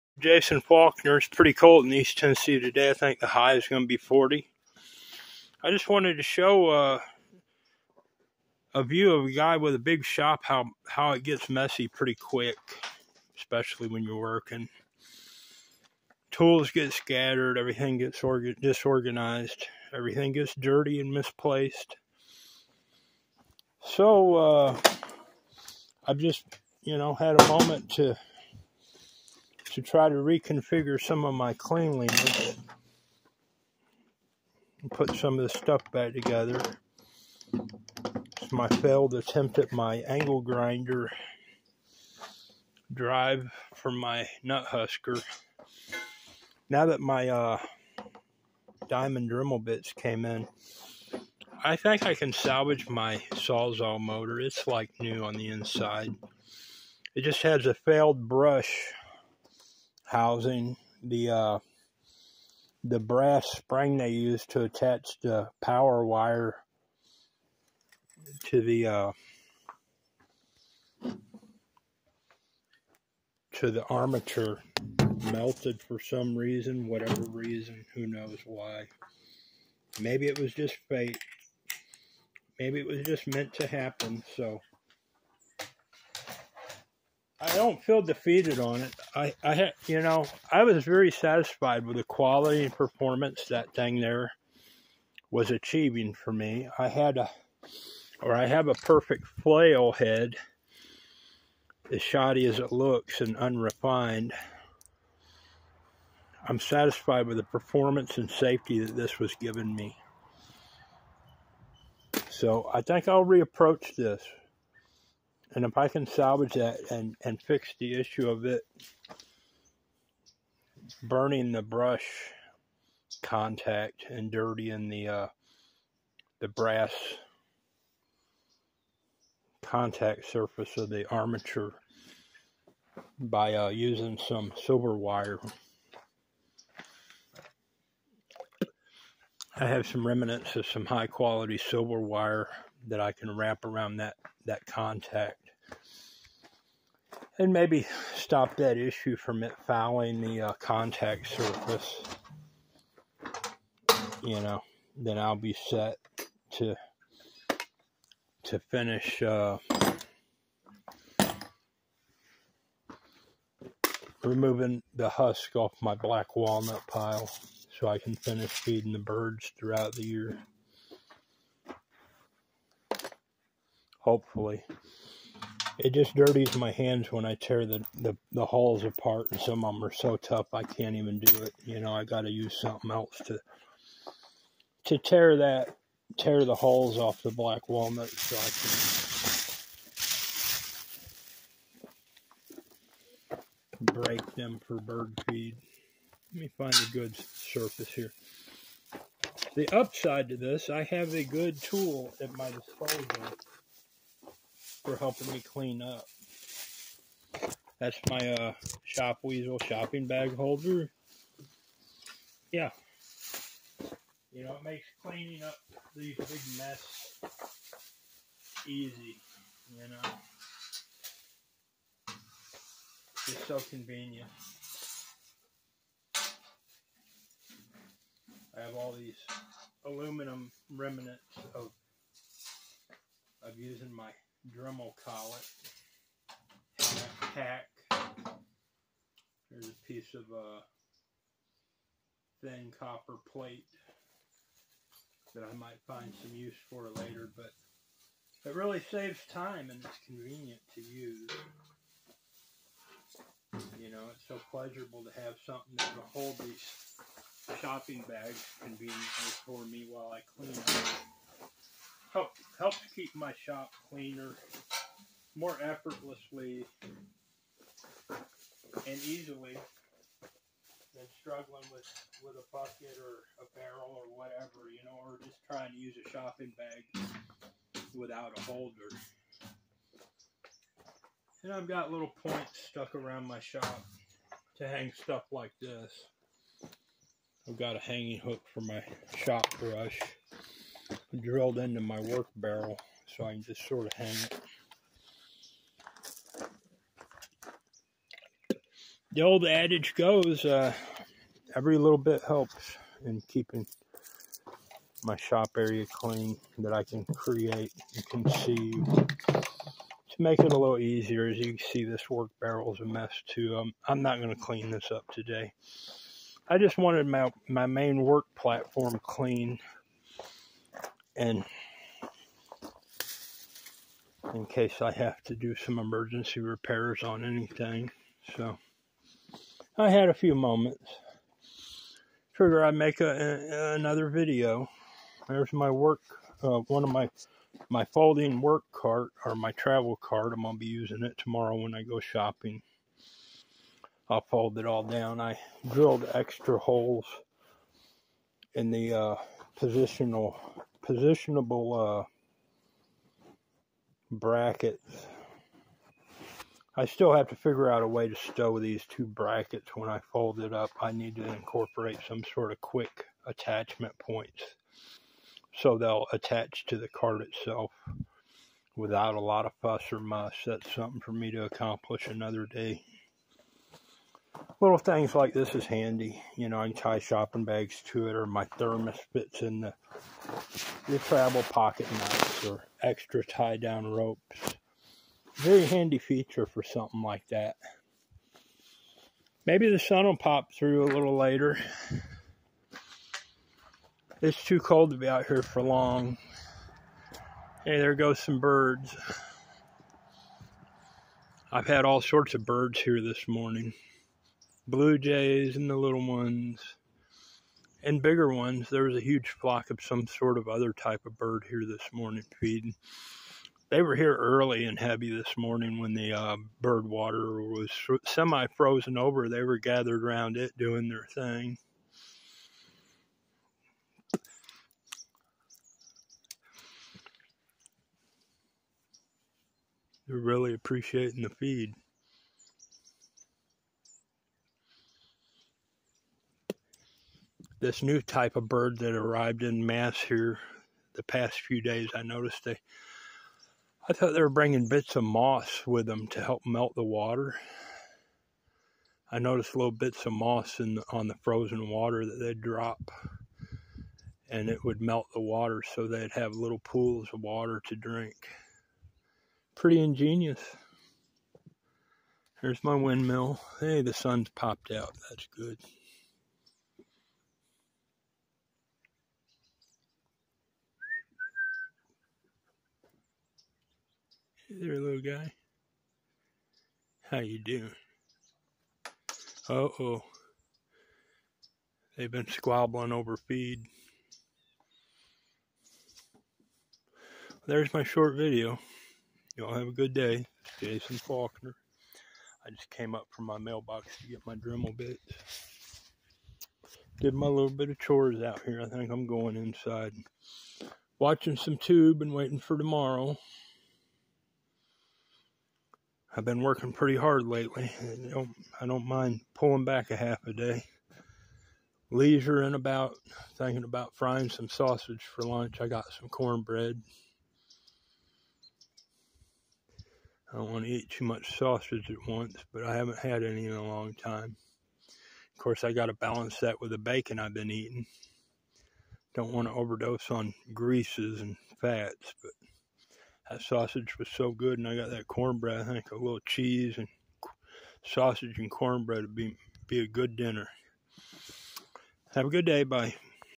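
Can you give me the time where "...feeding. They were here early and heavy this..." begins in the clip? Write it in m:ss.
6:52.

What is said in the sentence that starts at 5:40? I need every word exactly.
I'm gonna be using it tomorrow when I go shopping.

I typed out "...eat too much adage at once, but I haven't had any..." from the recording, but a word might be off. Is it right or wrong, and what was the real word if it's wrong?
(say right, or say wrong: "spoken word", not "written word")
wrong: "sausage", not "adage".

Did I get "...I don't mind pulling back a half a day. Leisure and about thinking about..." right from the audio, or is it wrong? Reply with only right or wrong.
right.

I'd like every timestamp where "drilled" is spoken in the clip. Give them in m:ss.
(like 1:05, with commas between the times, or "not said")
4:51, 5:45.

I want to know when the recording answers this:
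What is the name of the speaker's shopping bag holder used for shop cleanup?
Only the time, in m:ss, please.
3:28.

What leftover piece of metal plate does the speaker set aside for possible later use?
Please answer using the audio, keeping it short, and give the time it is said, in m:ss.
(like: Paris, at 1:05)
thin copper plate, at 4:02.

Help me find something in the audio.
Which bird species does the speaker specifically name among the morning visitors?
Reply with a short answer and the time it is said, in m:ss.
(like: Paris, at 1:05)
Blue jays, at 6:44.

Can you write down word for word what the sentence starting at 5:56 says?
I still have to figure out a way to stow these two brackets when I fold it up.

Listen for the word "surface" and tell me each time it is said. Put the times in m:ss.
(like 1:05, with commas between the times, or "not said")
2:10, 2:31, 3:17.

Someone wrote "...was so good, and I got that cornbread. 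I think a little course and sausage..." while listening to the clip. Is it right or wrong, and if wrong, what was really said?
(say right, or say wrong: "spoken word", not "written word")
wrong: "cheese", not "course".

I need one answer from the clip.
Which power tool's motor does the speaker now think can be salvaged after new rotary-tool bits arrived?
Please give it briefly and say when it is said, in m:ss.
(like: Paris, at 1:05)
Sawzall, at 0:53.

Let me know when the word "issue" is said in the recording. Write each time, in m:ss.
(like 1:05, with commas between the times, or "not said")
1:57, 2:28.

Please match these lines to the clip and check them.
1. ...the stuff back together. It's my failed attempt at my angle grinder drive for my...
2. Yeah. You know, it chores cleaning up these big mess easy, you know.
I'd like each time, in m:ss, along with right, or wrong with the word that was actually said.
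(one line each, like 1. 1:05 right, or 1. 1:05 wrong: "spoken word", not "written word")
1. 0:35 right
2. 3:32 wrong: "makes", not "chores".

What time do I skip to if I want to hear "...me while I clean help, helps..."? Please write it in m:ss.
4:19.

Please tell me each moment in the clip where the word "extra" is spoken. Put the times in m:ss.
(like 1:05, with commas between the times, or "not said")
5:46, 6:22.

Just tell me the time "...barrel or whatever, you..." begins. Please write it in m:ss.
4:33.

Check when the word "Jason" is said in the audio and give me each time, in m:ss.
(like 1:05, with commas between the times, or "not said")
0:00, 8:10.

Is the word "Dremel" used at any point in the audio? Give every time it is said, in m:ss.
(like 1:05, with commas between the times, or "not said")
0:49, 3:54, 8:14.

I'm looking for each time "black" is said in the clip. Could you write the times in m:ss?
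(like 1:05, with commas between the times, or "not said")
2:45, 3:07.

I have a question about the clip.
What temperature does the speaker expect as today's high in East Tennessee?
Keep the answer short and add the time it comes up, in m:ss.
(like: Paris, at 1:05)
40, at 0:03.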